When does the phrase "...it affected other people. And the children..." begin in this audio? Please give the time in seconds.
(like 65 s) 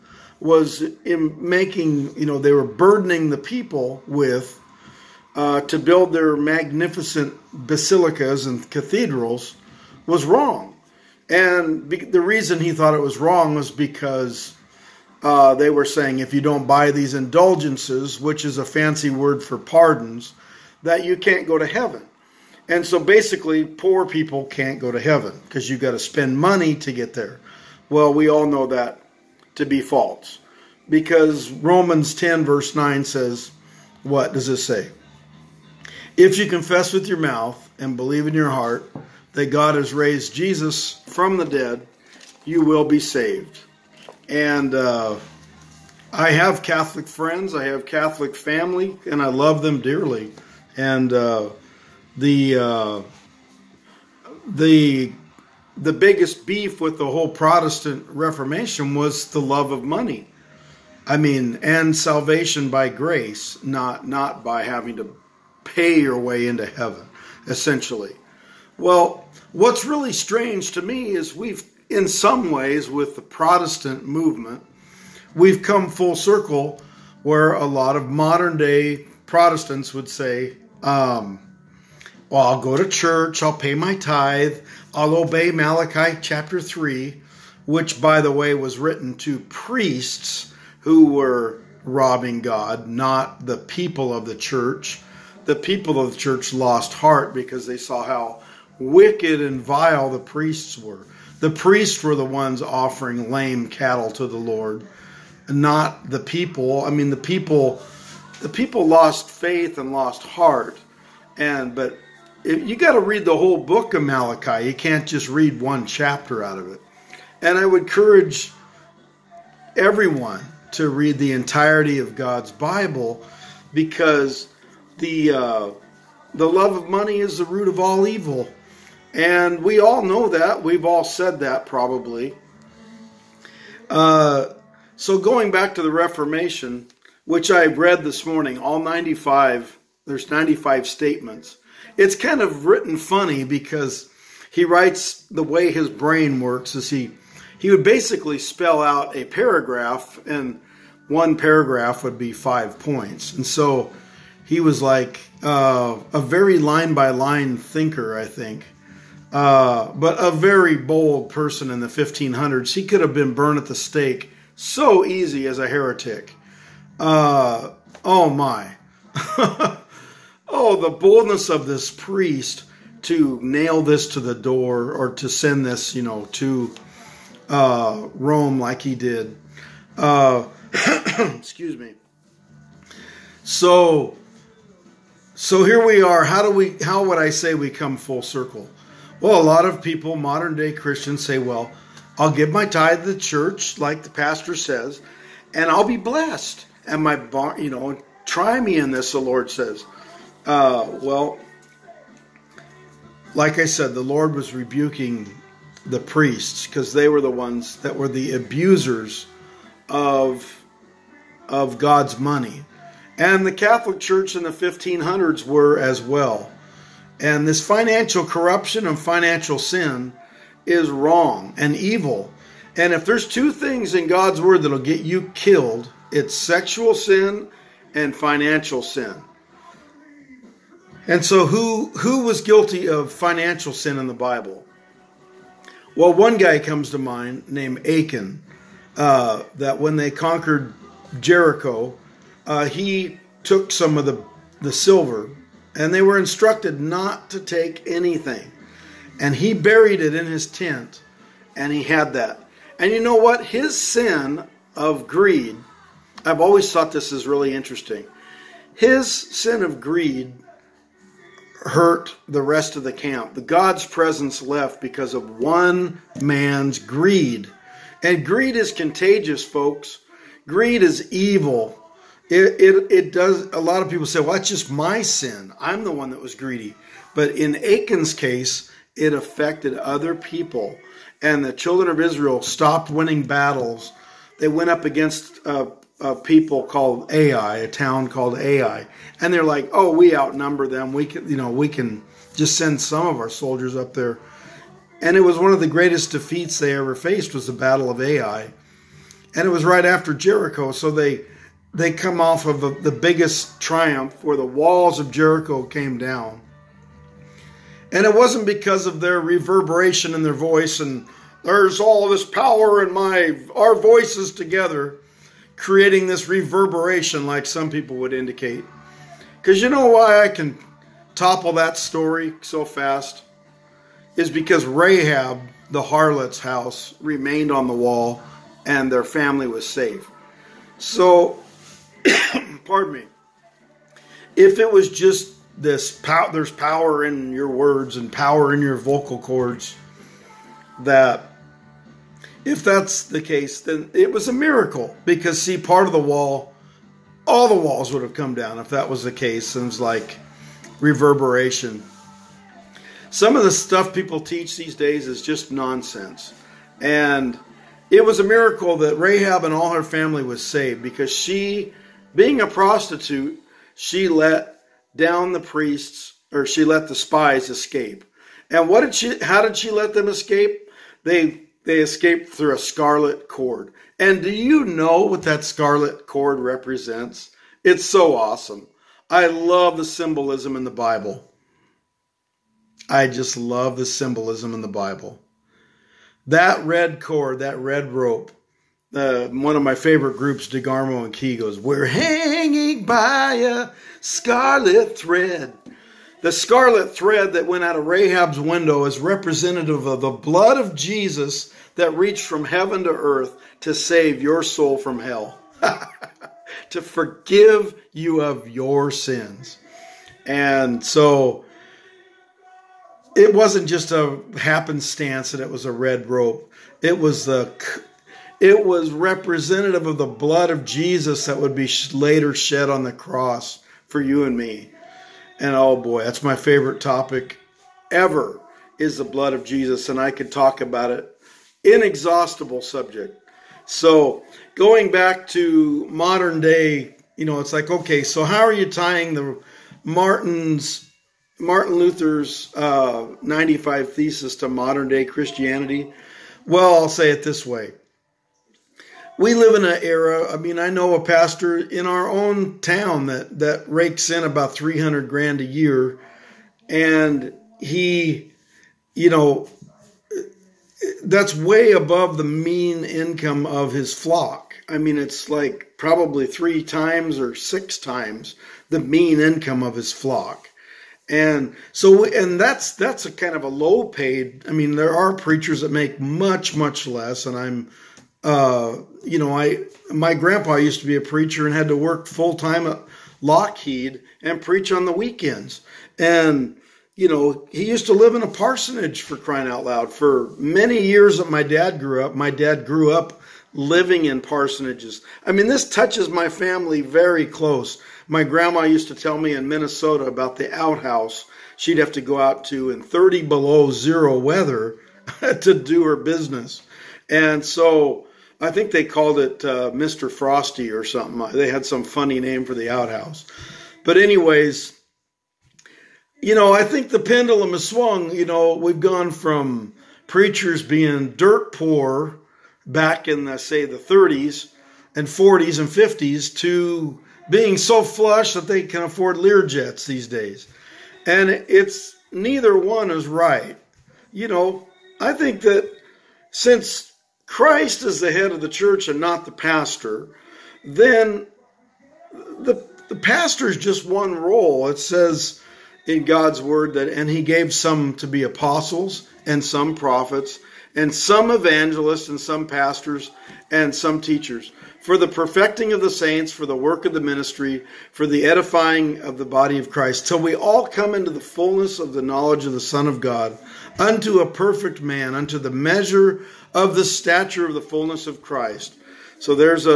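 278 s.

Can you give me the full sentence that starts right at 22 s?
And so basically, poor people can't go to heaven because you've got to spend money to get there.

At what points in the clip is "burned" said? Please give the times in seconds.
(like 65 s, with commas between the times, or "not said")
163 s.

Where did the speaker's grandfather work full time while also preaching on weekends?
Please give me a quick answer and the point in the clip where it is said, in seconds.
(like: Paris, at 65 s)
Lockheed, at 483 s.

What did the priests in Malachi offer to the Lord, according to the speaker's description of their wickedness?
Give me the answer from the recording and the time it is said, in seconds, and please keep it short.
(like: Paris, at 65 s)
Lame cattle, at 103 s.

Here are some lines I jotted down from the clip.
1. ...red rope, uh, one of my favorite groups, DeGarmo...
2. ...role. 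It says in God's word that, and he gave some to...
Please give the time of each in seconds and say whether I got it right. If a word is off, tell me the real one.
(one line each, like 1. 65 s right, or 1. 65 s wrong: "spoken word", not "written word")
1. 387 s right
2. 544 s right.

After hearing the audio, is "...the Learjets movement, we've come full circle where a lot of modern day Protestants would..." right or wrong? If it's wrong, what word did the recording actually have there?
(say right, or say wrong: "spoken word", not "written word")
wrong: "Protestant", not "Learjets".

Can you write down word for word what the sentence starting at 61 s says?
I mean, and salvation by grace, not not by having to pay your way into heaven, essentially.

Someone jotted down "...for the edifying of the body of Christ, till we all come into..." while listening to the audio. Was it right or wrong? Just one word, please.
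right.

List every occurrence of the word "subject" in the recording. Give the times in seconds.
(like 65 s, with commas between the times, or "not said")
432 s.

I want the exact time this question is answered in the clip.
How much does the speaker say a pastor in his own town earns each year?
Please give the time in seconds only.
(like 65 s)
454 s.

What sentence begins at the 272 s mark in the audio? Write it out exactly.
It, it, it does, a lot of people say, well, that's just my sin.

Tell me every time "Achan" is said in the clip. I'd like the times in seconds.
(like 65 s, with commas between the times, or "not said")
237 s, 277 s.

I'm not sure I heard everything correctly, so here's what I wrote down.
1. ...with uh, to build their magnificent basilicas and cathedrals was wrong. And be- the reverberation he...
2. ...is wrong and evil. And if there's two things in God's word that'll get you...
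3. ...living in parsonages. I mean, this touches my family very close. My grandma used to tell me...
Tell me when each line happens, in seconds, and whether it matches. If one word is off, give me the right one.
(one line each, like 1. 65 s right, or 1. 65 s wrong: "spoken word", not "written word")
1. 4 s wrong: "reason", not "reverberation"
2. 220 s right
3. 493 s right.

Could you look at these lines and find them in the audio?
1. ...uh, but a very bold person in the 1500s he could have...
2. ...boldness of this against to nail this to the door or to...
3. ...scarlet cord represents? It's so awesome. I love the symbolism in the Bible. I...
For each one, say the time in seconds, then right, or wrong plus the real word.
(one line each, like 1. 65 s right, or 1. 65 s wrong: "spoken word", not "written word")
1. 159 s right
2. 170 s wrong: "priest", not "against"
3. 375 s right.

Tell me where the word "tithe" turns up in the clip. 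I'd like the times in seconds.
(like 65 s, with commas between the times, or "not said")
83 s, 192 s.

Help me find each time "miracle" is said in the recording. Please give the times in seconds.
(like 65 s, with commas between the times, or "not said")
344 s, 358 s.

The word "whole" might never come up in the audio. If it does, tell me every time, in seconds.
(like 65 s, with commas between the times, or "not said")
57 s, 113 s.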